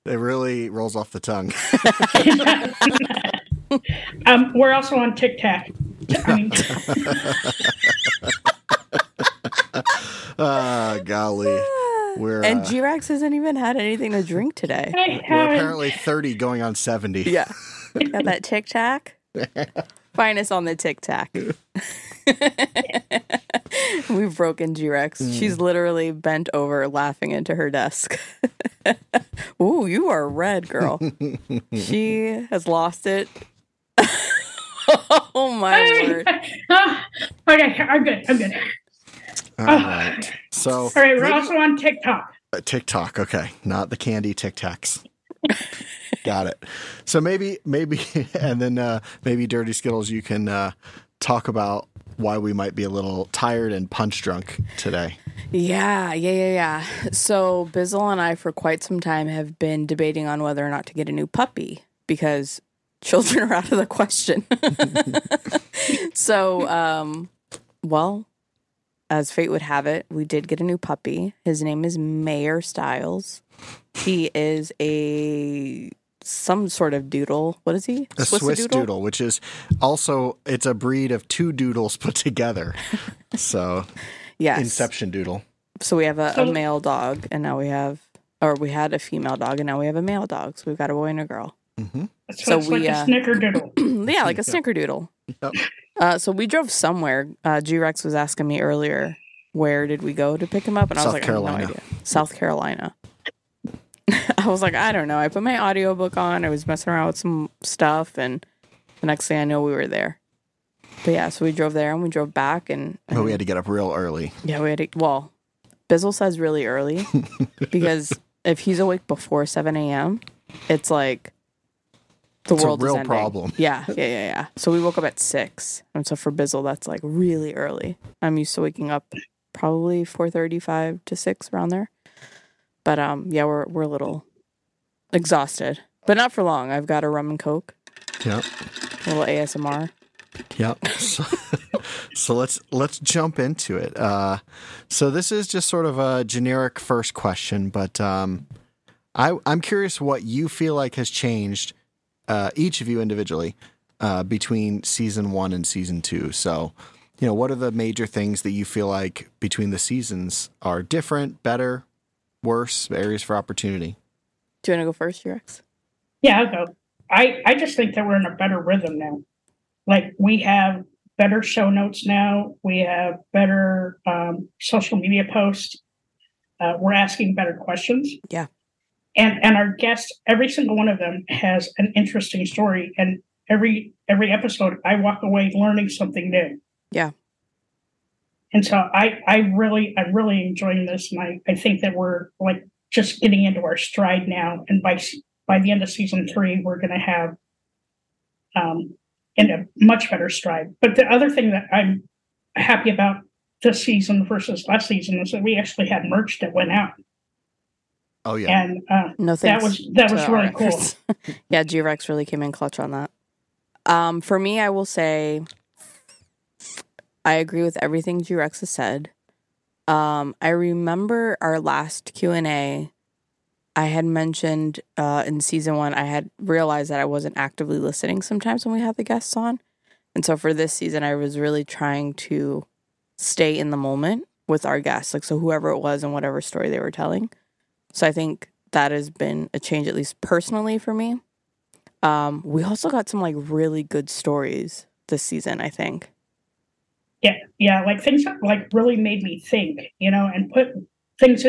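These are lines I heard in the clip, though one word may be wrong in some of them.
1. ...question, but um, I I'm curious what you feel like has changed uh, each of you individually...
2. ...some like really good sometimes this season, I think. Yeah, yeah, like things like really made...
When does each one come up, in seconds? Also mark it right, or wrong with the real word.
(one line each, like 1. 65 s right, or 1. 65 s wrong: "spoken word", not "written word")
1. 147 s right
2. 243 s wrong: "stories", not "sometimes".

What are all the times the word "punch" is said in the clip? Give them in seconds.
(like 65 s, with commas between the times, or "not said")
53 s.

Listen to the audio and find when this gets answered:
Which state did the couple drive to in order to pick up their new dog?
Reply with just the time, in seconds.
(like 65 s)
102 s.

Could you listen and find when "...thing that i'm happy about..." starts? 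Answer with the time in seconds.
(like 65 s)
201 s.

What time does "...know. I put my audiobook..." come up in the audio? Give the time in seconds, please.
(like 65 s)
105 s.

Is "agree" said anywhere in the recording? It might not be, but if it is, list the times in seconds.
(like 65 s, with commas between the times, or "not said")
217 s.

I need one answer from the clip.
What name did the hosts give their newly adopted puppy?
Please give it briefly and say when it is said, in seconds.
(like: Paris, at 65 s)
Mayor Styles, at 71 s.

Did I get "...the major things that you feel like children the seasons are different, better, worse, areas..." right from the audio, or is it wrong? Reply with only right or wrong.
wrong.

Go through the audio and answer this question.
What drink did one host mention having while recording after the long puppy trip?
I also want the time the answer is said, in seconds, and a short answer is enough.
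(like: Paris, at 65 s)
Rum and coke, at 137 s.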